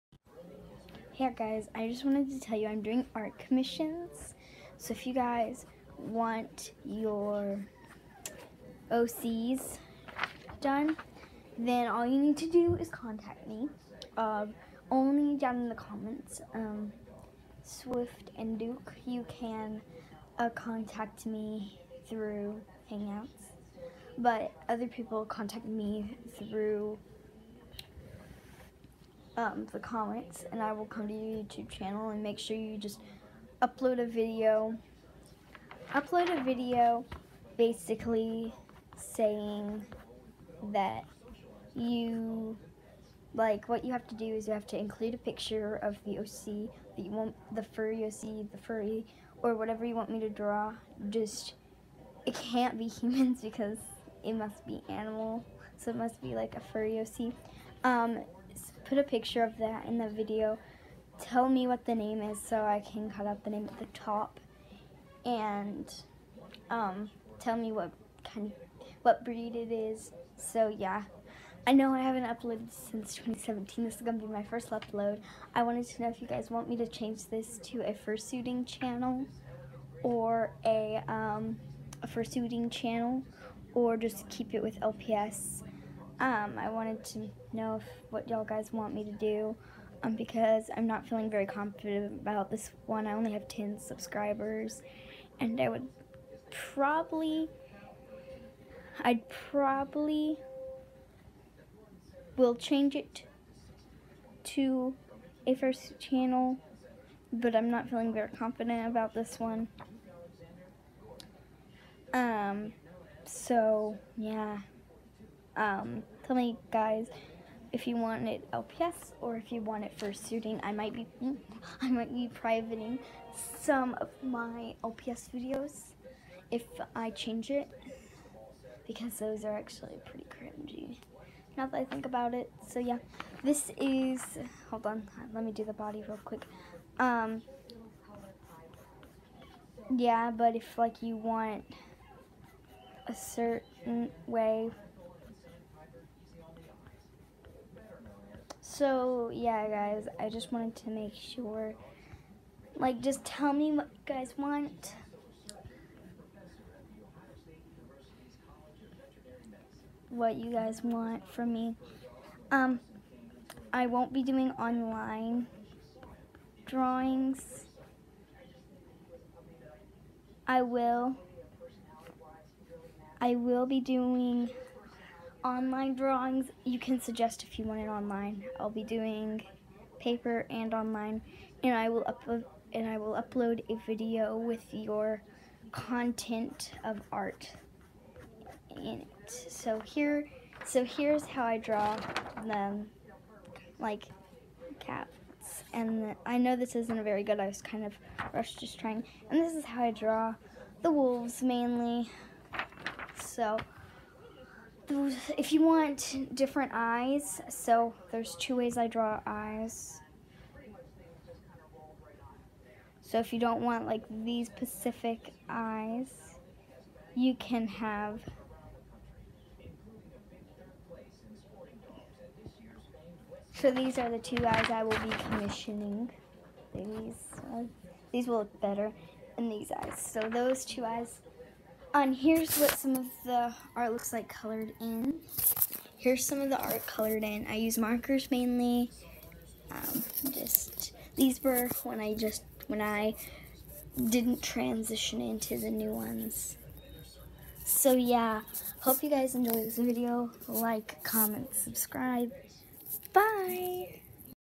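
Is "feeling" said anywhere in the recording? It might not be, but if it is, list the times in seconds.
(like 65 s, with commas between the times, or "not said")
91 s, 107 s.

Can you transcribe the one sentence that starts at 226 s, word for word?
These, uh, these will look better, in these eyes.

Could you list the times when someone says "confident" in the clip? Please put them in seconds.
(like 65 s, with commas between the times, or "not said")
91 s, 108 s.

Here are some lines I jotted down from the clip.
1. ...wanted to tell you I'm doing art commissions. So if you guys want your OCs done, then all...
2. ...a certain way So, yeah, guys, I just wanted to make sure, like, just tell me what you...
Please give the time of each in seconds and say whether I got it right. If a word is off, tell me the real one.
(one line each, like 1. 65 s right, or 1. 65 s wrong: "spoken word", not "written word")
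1. 2 s right
2. 143 s right.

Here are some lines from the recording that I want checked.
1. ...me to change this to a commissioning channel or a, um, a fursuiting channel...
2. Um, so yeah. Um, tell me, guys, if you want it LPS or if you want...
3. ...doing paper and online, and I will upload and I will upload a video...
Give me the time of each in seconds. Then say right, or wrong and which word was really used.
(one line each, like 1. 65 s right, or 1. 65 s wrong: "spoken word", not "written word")
1. 76 s wrong: "fursuiting", not "commissioning"
2. 112 s right
3. 178 s right.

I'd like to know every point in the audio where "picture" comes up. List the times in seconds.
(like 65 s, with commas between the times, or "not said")
45 s, 59 s.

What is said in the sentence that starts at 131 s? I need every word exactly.
Now that I think about it, so yeah, this is, hold on, let me do the body real quick.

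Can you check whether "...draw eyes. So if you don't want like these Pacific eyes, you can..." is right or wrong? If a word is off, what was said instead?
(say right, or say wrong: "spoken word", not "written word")
right.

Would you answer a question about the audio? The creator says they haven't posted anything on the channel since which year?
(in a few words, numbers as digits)
2017.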